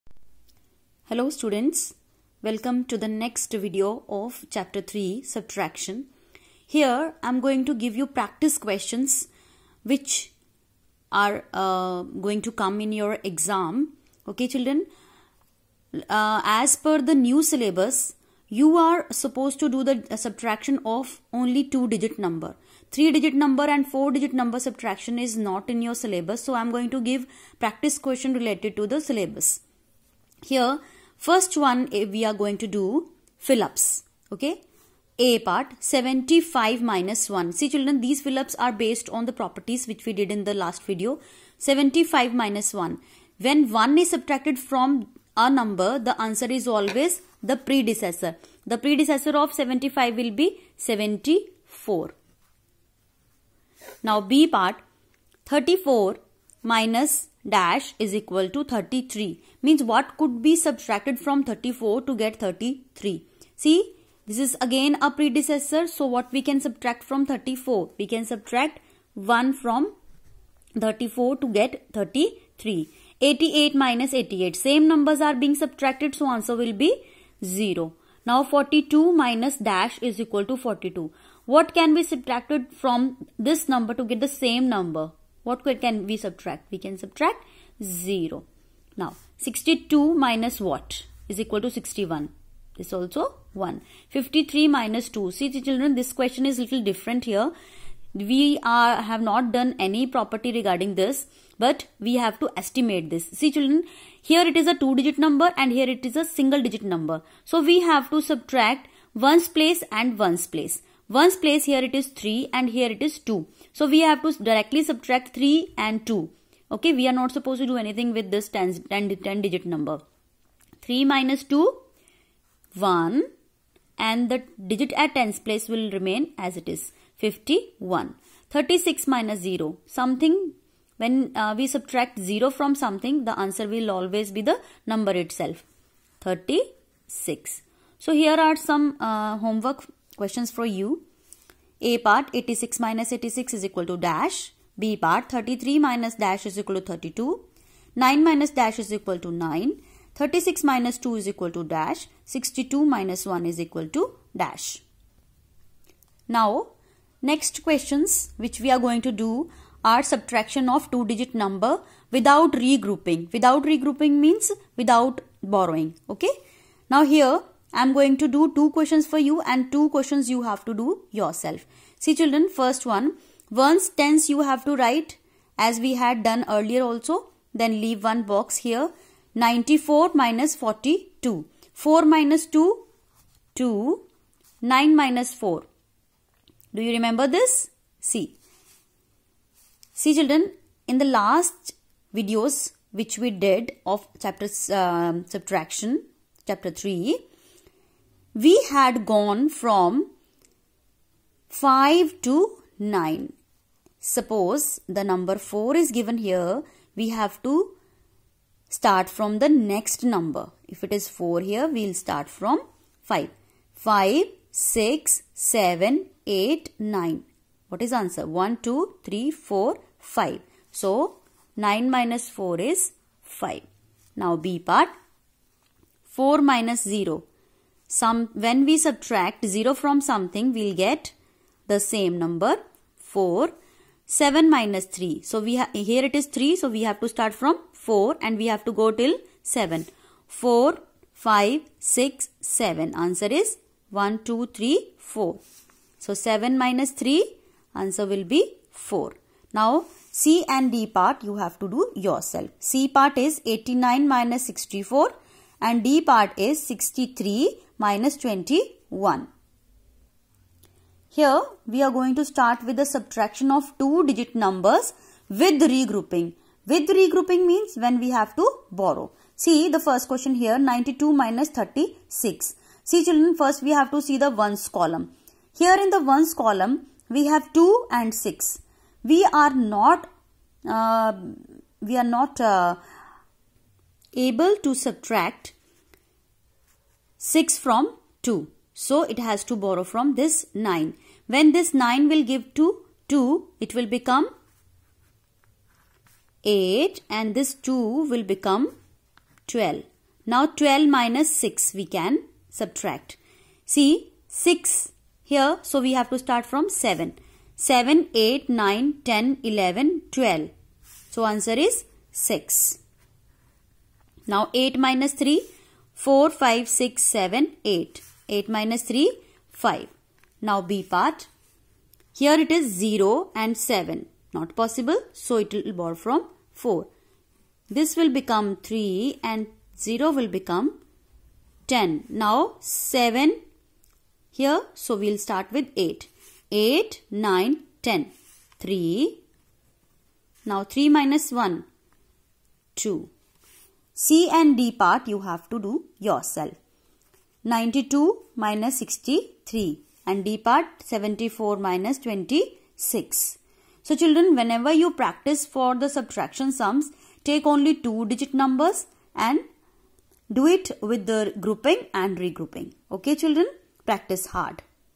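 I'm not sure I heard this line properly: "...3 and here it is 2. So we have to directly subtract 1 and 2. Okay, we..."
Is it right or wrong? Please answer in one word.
wrong.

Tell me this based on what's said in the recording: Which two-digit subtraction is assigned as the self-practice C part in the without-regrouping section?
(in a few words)
89 minus 64.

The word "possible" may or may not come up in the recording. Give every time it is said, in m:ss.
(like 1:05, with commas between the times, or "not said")
5:24.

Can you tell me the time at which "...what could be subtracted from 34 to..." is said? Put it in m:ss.
0:59.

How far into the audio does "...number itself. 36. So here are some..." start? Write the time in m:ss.
2:14.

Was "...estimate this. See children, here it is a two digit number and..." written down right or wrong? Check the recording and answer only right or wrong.
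right.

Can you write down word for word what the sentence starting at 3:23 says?
Suppose the number 4 is given here, we have to start from the next number.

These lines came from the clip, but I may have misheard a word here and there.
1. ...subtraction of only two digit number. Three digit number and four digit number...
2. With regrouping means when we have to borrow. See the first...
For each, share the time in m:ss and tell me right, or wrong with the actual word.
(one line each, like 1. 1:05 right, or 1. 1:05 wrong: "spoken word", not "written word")
1. 0:20 right
2. 4:26 right.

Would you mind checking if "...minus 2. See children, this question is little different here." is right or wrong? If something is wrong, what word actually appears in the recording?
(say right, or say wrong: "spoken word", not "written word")
right.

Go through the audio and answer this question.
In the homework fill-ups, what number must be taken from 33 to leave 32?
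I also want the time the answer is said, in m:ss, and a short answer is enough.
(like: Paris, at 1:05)
33 minus dash is equal to 32, at 2:25.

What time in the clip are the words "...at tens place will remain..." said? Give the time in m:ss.
2:04.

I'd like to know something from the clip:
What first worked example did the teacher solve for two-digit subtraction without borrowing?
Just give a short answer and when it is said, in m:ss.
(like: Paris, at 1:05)
94 minus 42, at 2:59.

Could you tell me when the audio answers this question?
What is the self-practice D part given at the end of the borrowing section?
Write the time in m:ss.
5:50.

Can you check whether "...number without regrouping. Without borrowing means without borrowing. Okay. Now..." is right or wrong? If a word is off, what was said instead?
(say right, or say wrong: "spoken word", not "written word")
wrong: "regrouping", not "borrowing".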